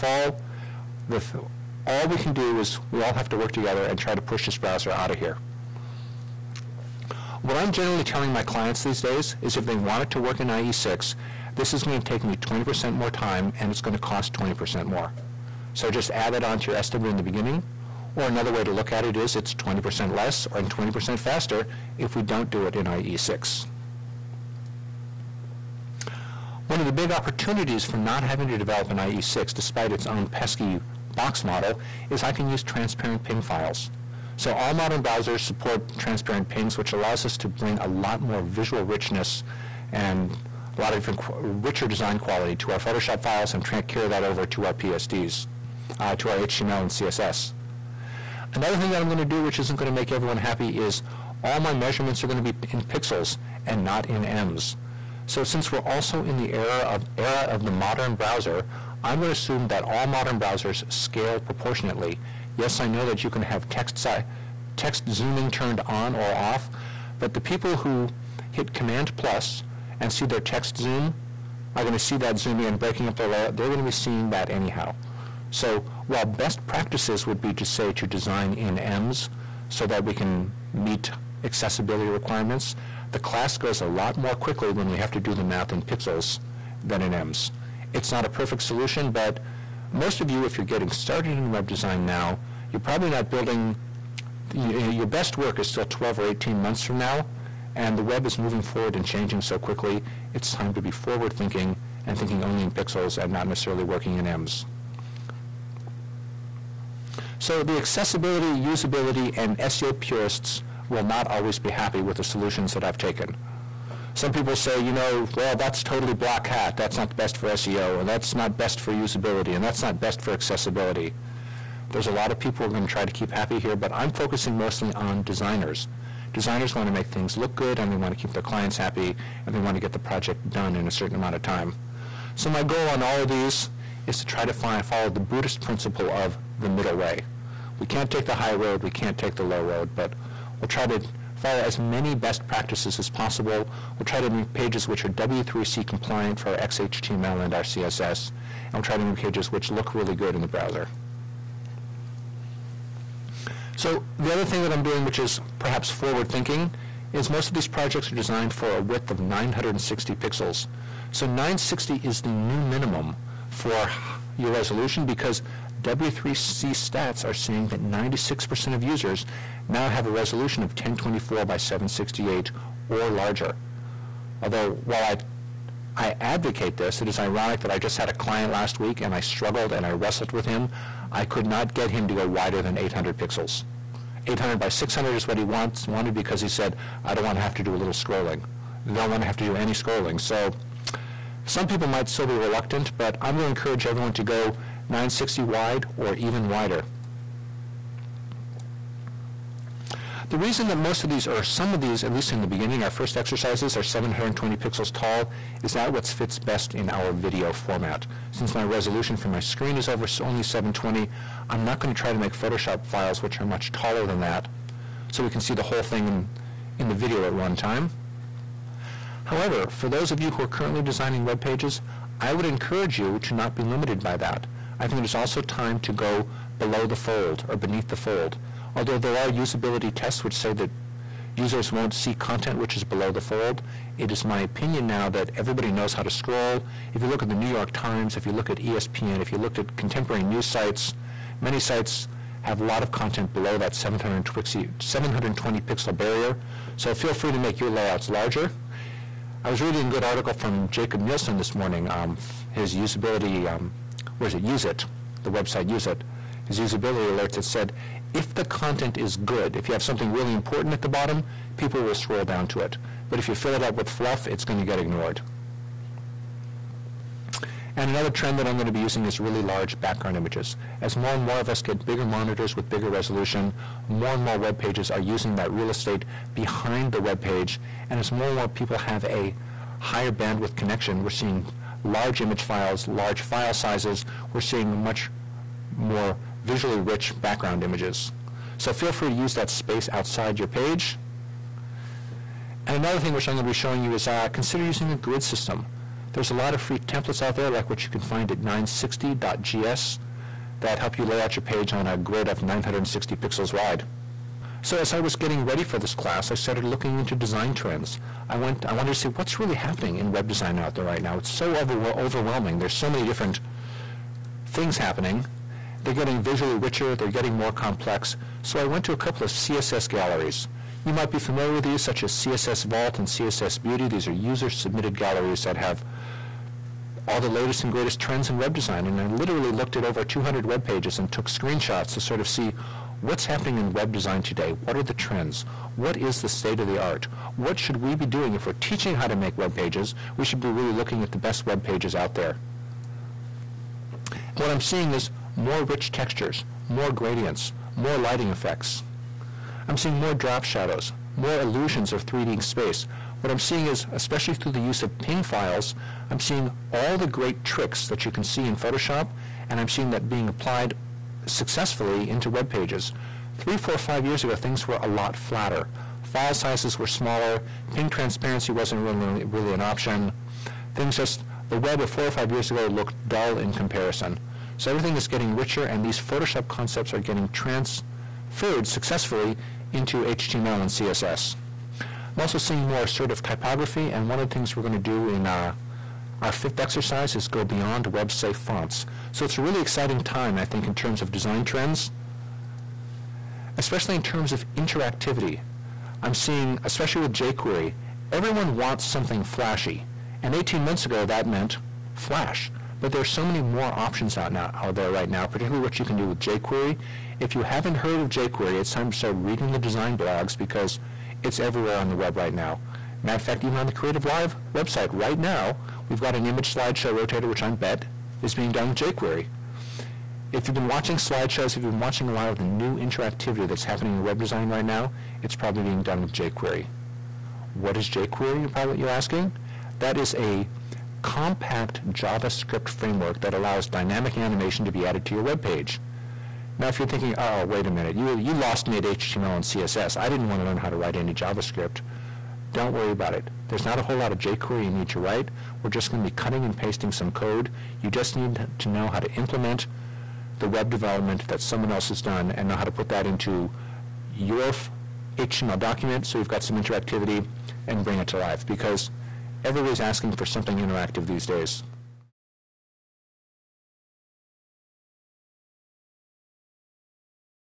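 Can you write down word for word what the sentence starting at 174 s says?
Although, while I I advocate this.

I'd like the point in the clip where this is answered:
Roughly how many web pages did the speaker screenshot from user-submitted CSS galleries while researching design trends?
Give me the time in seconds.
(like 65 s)
330 s.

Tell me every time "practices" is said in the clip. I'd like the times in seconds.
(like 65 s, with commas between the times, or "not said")
76 s, 142 s.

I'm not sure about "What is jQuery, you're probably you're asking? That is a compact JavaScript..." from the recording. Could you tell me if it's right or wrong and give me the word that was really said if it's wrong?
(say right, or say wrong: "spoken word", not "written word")
right.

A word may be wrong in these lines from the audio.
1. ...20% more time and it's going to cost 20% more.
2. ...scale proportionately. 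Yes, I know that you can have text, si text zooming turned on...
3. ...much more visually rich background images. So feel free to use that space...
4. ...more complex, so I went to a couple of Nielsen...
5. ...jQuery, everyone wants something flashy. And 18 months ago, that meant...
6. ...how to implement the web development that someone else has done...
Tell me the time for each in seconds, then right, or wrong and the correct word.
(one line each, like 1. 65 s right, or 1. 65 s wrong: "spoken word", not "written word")
1. 12 s right
2. 60 s right
3. 284 s right
4. 317 s wrong: "CSS", not "Nielsen"
5. 397 s right
6. 448 s right.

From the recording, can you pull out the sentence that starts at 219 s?
However, for those of you who are currently designing web pages, I would encourage you to not be limited by that.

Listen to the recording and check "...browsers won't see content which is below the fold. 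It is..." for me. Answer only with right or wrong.
wrong.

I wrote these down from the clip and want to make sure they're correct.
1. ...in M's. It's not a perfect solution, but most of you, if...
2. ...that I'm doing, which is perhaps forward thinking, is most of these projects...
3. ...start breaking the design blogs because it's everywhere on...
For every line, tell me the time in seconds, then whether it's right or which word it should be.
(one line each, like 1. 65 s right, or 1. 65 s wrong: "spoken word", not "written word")
1. 87 s right
2. 154 s right
3. 408 s wrong: "reading", not "breaking".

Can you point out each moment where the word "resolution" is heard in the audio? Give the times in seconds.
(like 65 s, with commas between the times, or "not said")
164 s, 170 s, 208 s, 272 s.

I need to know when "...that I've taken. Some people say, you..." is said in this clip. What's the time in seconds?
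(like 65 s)
112 s.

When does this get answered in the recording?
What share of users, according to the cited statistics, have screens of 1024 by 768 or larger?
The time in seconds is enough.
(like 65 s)
167 s.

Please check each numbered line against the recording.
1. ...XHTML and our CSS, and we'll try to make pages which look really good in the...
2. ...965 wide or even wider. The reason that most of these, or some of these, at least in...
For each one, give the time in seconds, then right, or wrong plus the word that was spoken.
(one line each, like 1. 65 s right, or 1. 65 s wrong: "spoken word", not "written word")
1. 146 s right
2. 194 s wrong: "960", not "965".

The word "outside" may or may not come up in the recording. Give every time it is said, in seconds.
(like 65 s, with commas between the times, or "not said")
289 s.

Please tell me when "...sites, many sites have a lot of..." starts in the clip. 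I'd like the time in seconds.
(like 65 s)
240 s.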